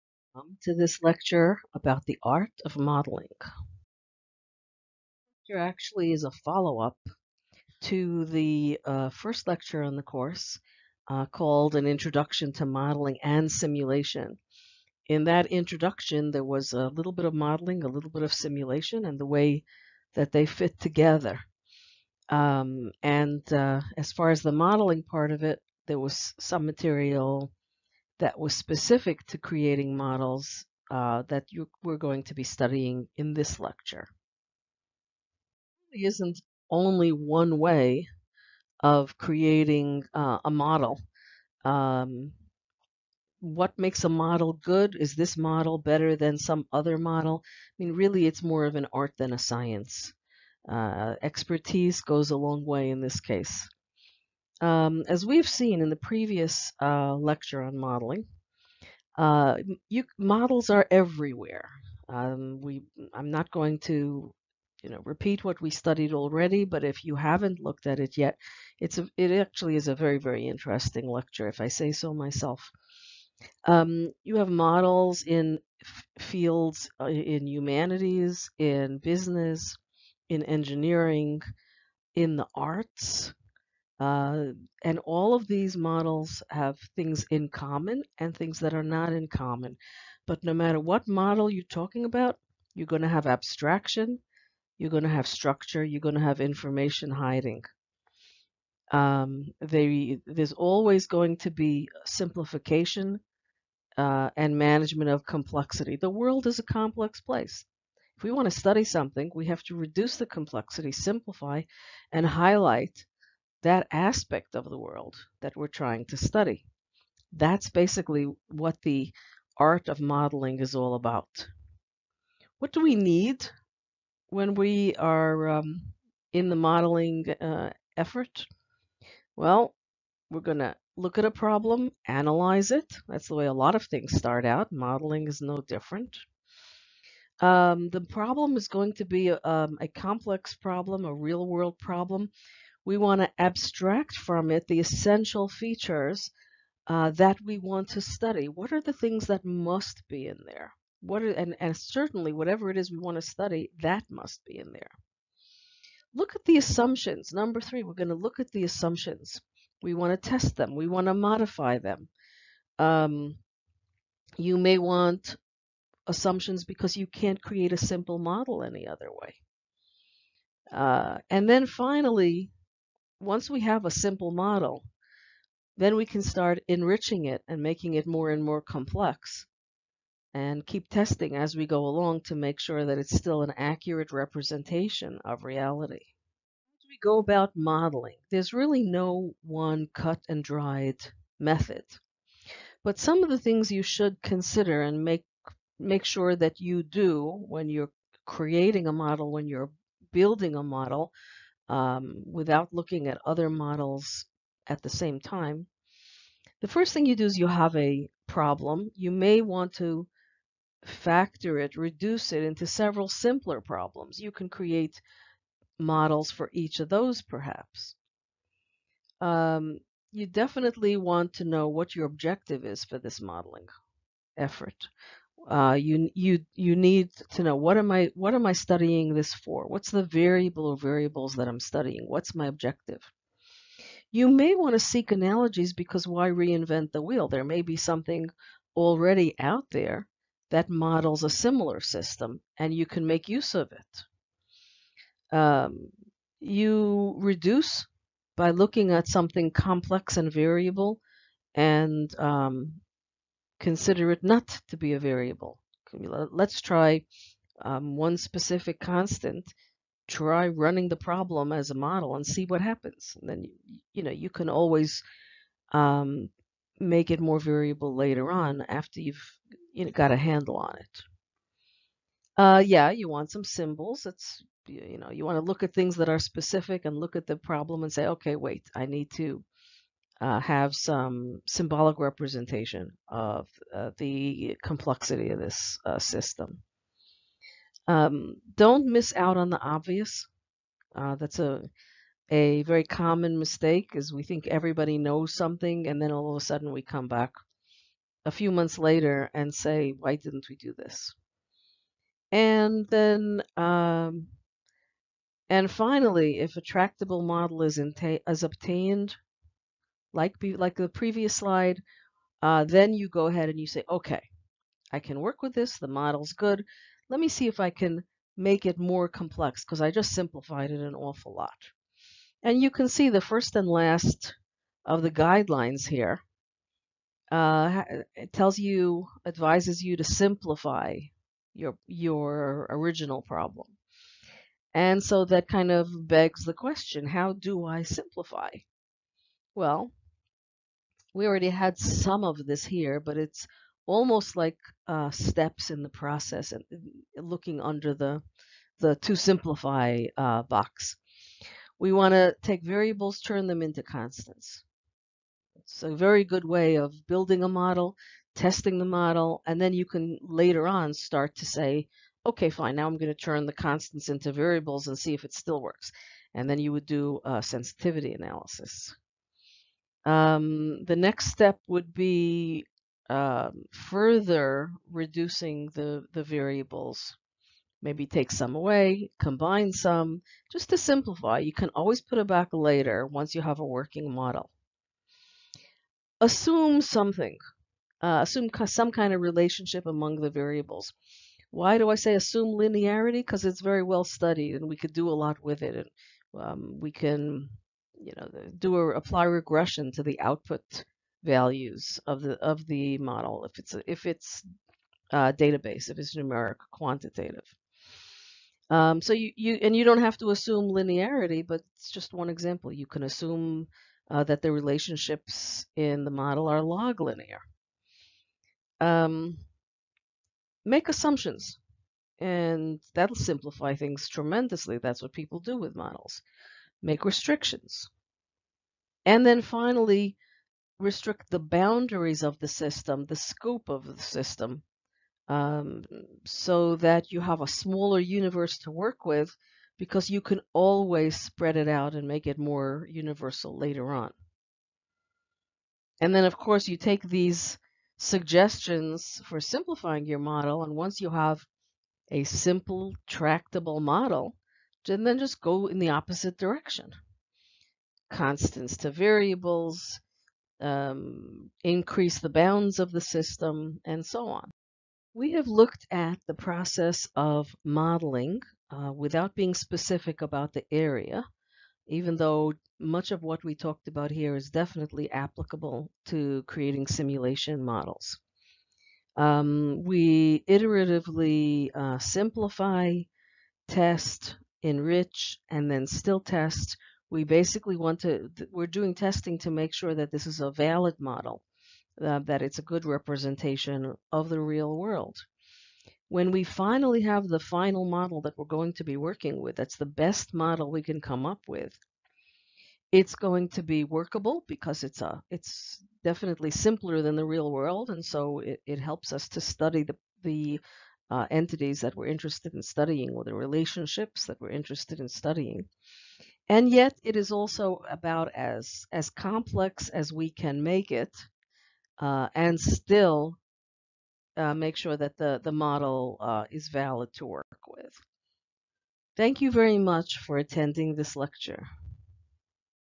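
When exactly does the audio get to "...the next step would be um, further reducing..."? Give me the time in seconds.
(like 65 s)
370 s.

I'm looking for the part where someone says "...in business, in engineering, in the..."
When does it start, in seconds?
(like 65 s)
78 s.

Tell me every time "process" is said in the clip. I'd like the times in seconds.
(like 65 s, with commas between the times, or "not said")
345 s, 466 s.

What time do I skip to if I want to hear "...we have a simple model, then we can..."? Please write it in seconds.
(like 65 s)
173 s.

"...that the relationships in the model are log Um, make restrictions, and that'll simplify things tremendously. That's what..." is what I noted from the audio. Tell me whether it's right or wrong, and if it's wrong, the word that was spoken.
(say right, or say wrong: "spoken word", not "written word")
wrong: "assumptions", not "restrictions".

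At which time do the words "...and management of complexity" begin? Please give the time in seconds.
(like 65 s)
104 s.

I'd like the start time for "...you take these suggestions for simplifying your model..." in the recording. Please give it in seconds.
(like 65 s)
446 s.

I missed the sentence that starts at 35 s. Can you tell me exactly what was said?
There isn't only one way of creating uh, a model.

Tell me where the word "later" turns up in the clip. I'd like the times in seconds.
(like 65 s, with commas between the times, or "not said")
267 s, 298 s, 360 s, 382 s, 443 s.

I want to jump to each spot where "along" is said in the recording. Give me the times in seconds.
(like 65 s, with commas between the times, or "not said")
181 s.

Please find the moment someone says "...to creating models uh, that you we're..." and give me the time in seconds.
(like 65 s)
29 s.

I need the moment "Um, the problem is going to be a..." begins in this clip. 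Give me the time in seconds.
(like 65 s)
137 s.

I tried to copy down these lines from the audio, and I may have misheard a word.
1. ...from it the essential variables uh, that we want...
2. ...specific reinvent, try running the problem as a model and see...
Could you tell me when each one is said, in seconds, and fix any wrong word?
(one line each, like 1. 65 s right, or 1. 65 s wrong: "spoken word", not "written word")
1. 144 s wrong: "features", not "variables"
2. 258 s wrong: "constant", not "reinvent".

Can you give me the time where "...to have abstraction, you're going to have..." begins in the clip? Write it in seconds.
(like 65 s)
93 s.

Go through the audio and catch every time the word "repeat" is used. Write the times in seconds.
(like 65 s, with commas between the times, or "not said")
65 s.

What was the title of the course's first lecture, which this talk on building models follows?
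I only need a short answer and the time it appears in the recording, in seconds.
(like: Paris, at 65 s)
An Introduction to Modeling and Simulation, at 11 s.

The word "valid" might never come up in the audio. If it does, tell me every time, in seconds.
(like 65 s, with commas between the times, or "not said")
490 s, 526 s.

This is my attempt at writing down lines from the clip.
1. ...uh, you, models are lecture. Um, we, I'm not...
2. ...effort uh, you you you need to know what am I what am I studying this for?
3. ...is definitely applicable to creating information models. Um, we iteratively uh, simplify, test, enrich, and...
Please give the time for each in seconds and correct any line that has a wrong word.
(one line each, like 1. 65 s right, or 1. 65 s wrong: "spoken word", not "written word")
1. 59 s wrong: "everywhere", not "lecture"
2. 224 s right
3. 474 s wrong: "simulation", not "information".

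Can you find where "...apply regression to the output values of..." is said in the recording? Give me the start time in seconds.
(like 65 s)
398 s.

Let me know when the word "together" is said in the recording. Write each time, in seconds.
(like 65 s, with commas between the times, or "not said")
20 s.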